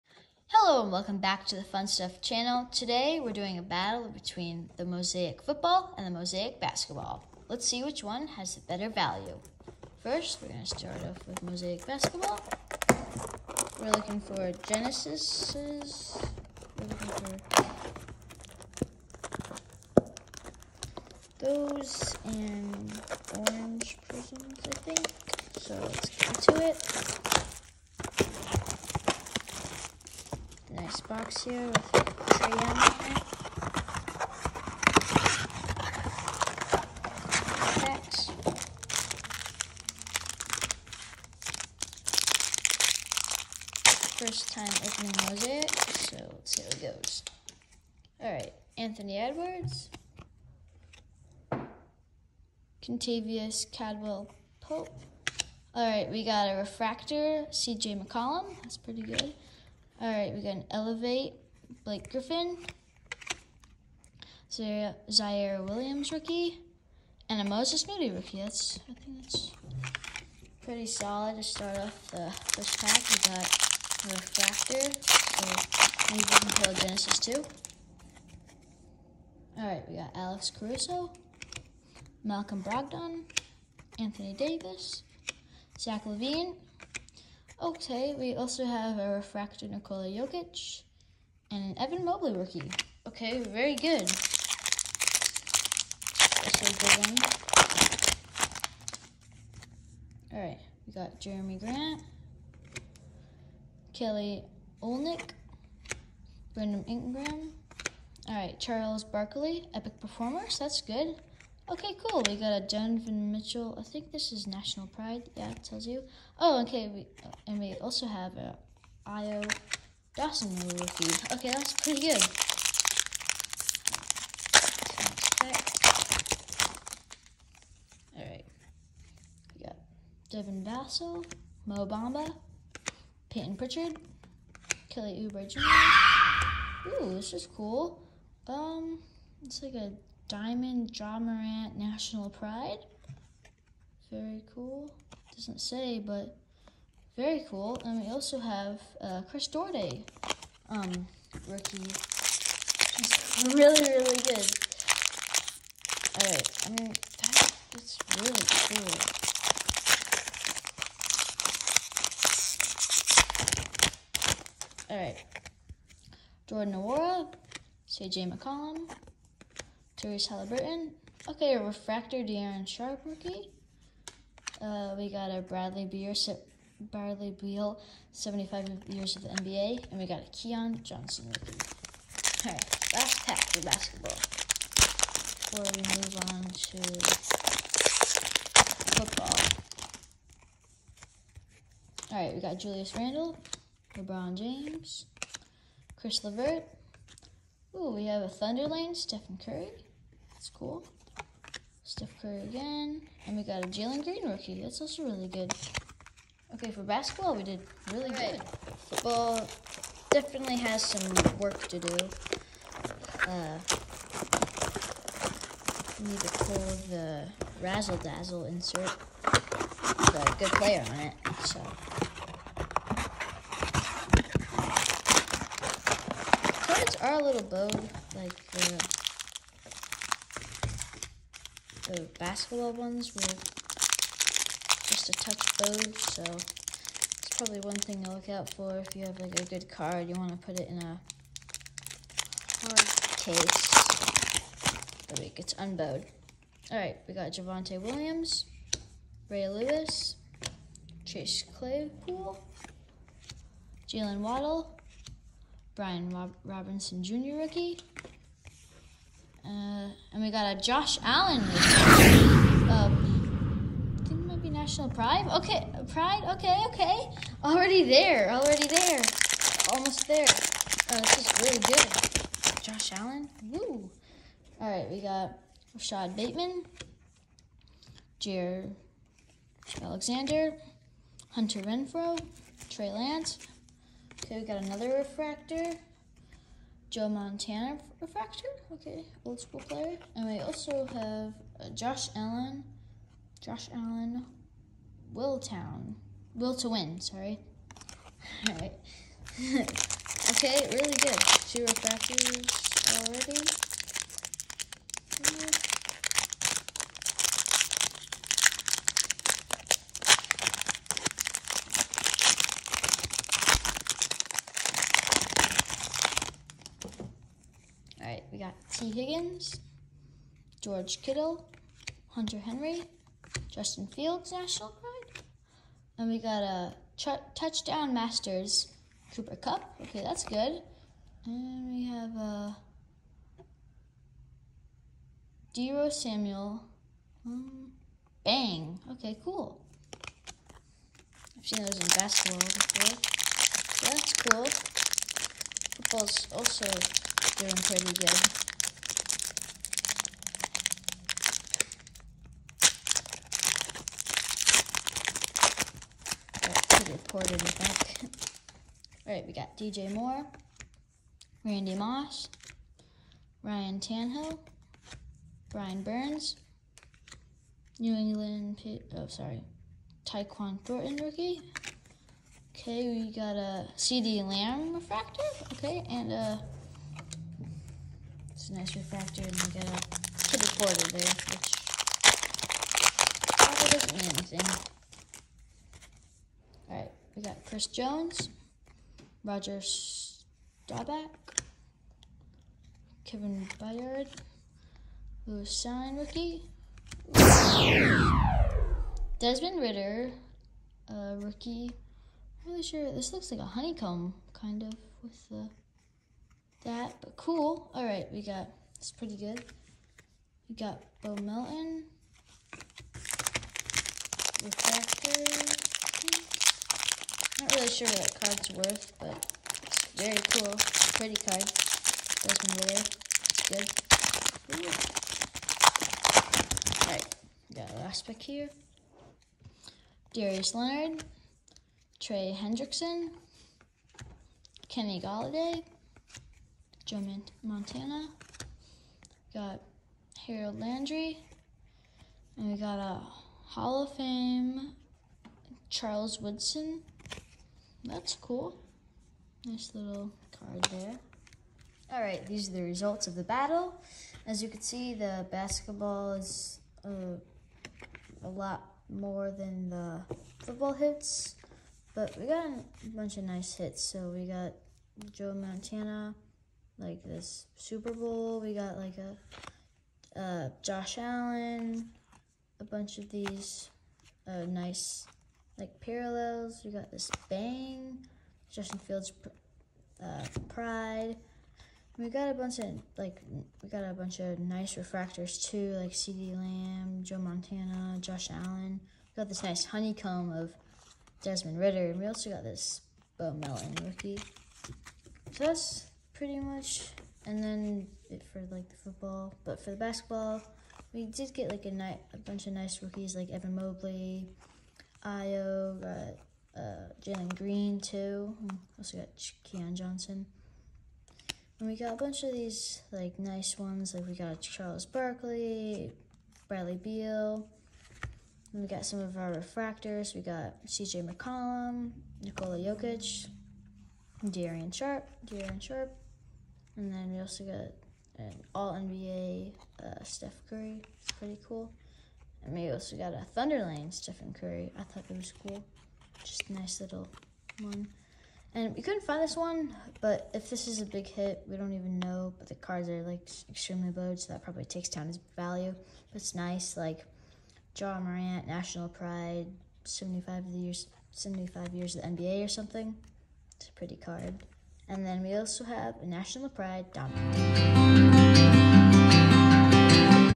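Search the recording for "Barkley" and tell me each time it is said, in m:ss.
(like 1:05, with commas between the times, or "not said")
1:49, 8:34.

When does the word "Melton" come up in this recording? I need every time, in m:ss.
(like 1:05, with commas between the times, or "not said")
6:51, 8:13.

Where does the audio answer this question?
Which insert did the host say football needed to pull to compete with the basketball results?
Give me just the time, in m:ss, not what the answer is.
3:37.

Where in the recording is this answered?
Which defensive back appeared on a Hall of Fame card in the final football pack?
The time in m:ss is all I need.
7:25.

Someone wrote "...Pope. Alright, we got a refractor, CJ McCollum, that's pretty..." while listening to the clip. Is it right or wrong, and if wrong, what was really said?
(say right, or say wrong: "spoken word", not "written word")
right.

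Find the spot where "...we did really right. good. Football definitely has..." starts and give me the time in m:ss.
3:27.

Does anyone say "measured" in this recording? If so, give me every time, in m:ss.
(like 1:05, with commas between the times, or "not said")
not said.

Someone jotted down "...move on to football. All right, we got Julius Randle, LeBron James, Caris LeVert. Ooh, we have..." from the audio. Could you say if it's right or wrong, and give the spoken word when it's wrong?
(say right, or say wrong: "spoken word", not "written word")
right.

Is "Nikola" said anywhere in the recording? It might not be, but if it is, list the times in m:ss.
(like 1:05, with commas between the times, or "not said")
1:29, 8:42.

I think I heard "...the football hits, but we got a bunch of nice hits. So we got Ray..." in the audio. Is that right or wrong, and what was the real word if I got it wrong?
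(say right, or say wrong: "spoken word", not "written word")
wrong: "Joe", not "Ray".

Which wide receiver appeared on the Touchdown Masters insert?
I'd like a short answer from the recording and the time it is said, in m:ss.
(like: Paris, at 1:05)
Cooper Kupp, at 5:29.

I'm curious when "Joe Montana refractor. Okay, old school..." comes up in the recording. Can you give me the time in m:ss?
4:46.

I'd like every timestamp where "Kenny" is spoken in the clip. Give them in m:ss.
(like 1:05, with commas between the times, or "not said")
7:14.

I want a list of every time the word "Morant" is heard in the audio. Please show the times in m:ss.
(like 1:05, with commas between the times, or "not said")
2:21, 9:07.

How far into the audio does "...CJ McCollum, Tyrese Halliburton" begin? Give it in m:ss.
2:47.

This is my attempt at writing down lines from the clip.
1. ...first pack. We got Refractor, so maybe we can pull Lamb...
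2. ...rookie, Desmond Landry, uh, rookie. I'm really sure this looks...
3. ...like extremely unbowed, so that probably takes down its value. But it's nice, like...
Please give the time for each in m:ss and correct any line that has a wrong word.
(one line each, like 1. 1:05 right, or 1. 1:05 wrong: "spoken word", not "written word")
1. 1:12 wrong: "Genesis", not "Lamb"
2. 6:35 wrong: "Ridder", not "Landry"
3. 9:03 wrong: "bowed", not "unbowed".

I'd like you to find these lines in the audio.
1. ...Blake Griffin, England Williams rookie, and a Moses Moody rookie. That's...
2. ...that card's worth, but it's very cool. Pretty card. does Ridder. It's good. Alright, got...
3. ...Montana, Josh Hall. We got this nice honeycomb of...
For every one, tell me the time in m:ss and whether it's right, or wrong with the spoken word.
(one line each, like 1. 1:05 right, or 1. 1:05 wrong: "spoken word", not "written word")
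1. 1:01 wrong: "Ziaire", not "England"
2. 6:57 right
3. 8:07 wrong: "Allen", not "Hall".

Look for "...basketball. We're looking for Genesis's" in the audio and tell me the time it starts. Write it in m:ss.
0:11.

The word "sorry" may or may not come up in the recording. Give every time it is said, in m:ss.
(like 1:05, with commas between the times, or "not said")
4:56, 6:09.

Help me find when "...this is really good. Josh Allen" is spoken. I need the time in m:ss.
4:31.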